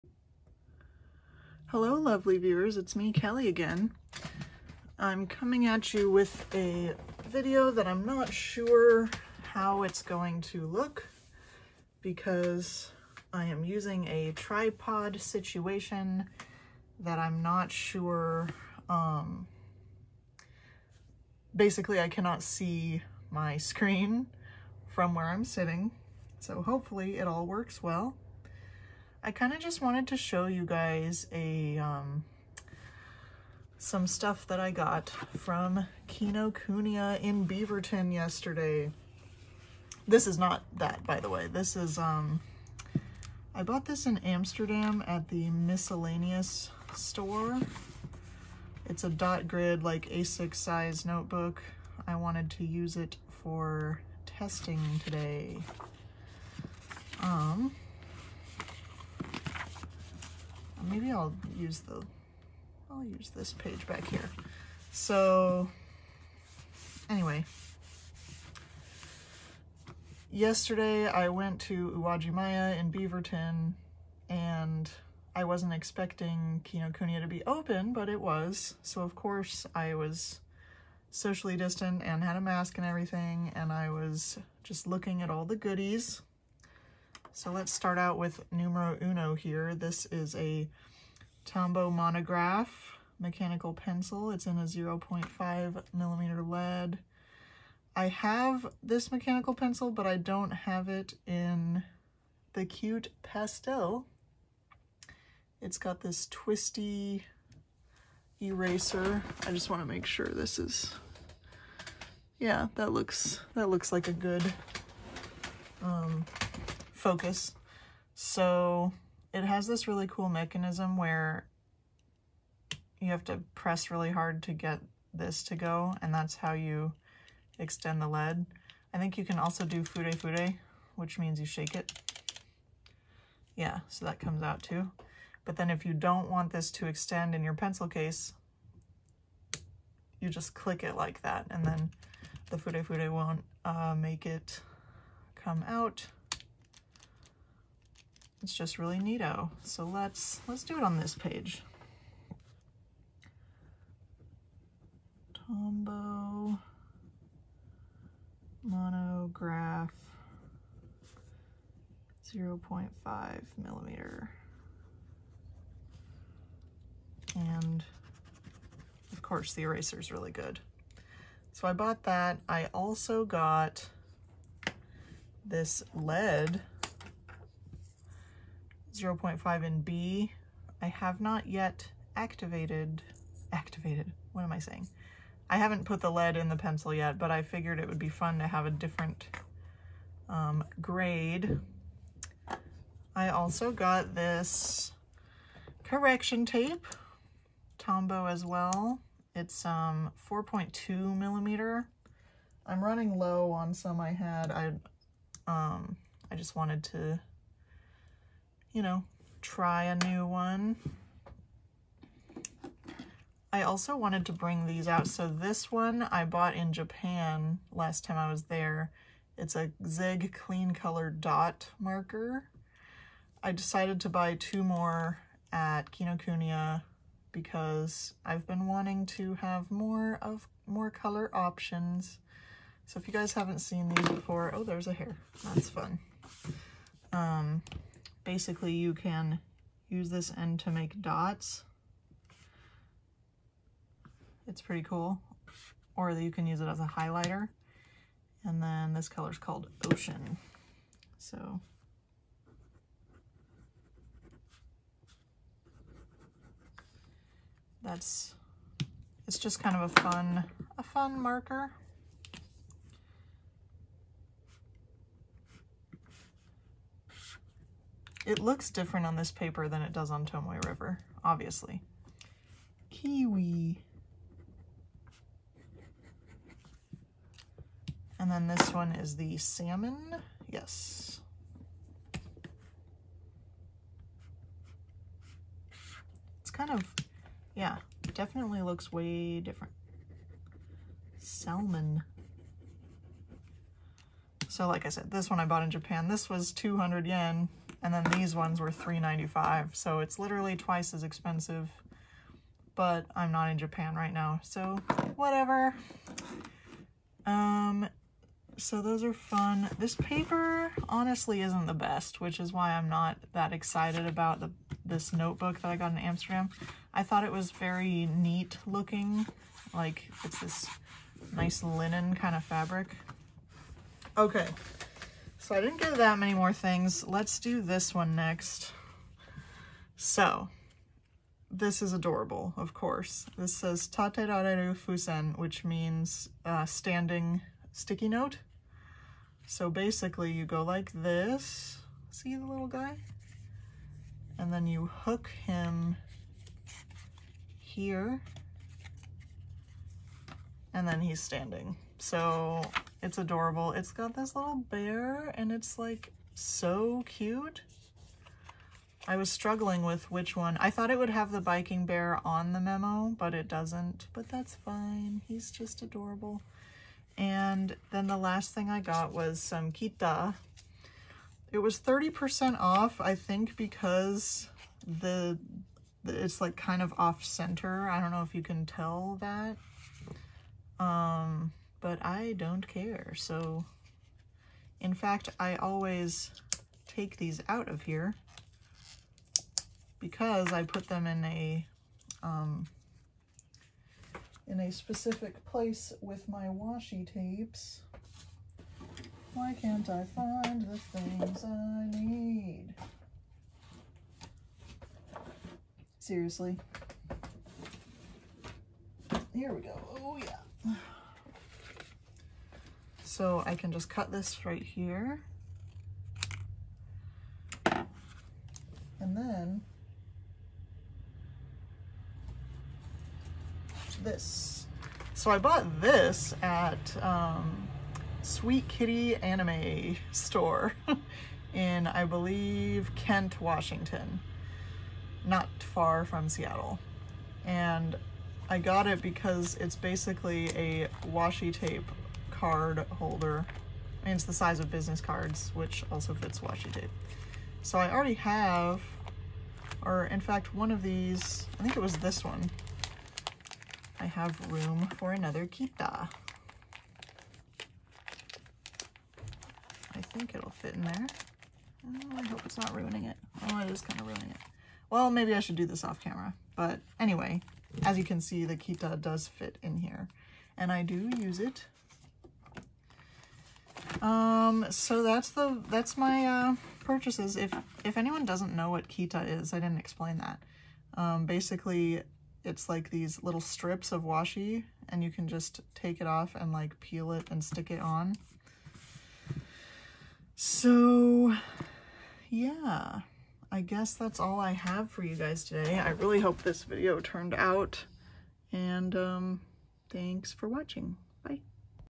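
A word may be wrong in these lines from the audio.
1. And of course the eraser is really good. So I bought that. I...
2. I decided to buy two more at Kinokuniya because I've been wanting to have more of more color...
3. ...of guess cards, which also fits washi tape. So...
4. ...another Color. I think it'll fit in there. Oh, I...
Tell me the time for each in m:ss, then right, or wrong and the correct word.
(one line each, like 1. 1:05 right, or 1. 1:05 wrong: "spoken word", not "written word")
1. 2:47 right
2. 3:43 right
3. 7:24 wrong: "business", not "guess"
4. 7:35 wrong: "Kitta", not "Color".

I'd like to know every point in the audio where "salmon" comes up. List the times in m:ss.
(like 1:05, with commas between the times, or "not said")
4:39, 4:51.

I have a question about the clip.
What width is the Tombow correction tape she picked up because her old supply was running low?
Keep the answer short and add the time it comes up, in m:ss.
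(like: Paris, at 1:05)
4.2 millimeter, at 3:20.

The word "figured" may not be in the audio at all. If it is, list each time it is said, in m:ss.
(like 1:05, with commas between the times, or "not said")
3:07.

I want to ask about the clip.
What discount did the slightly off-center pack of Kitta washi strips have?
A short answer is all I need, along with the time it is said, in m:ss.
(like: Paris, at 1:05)
30%, at 6:11.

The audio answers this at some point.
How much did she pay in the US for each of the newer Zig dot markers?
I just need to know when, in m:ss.
4:58.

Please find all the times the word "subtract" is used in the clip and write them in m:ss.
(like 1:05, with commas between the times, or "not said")
not said.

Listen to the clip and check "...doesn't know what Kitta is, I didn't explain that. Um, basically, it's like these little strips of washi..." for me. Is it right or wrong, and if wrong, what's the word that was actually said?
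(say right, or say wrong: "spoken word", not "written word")
right.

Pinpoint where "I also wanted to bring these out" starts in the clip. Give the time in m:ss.
3:33.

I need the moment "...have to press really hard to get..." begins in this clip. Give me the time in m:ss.
2:03.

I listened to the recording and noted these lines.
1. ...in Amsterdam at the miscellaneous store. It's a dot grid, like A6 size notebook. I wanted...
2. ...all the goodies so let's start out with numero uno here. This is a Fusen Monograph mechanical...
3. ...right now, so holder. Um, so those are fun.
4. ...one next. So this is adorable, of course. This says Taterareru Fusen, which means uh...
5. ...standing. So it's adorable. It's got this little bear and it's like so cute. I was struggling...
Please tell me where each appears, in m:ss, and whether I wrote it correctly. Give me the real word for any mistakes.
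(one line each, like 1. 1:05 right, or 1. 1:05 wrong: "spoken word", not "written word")
1. 0:44 right
2. 1:25 wrong: "Tombow", not "Fusen"
3. 5:03 wrong: "whatever", not "holder"
4. 5:27 right
5. 5:51 right.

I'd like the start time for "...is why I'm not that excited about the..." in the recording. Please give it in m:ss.
5:12.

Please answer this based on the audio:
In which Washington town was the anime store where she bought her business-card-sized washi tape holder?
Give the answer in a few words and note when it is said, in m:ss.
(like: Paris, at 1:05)
Kent, at 7:12.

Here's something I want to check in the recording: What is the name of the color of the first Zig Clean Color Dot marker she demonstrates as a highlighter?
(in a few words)
Ocean.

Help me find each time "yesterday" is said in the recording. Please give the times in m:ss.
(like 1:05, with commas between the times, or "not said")
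0:38, 1:10.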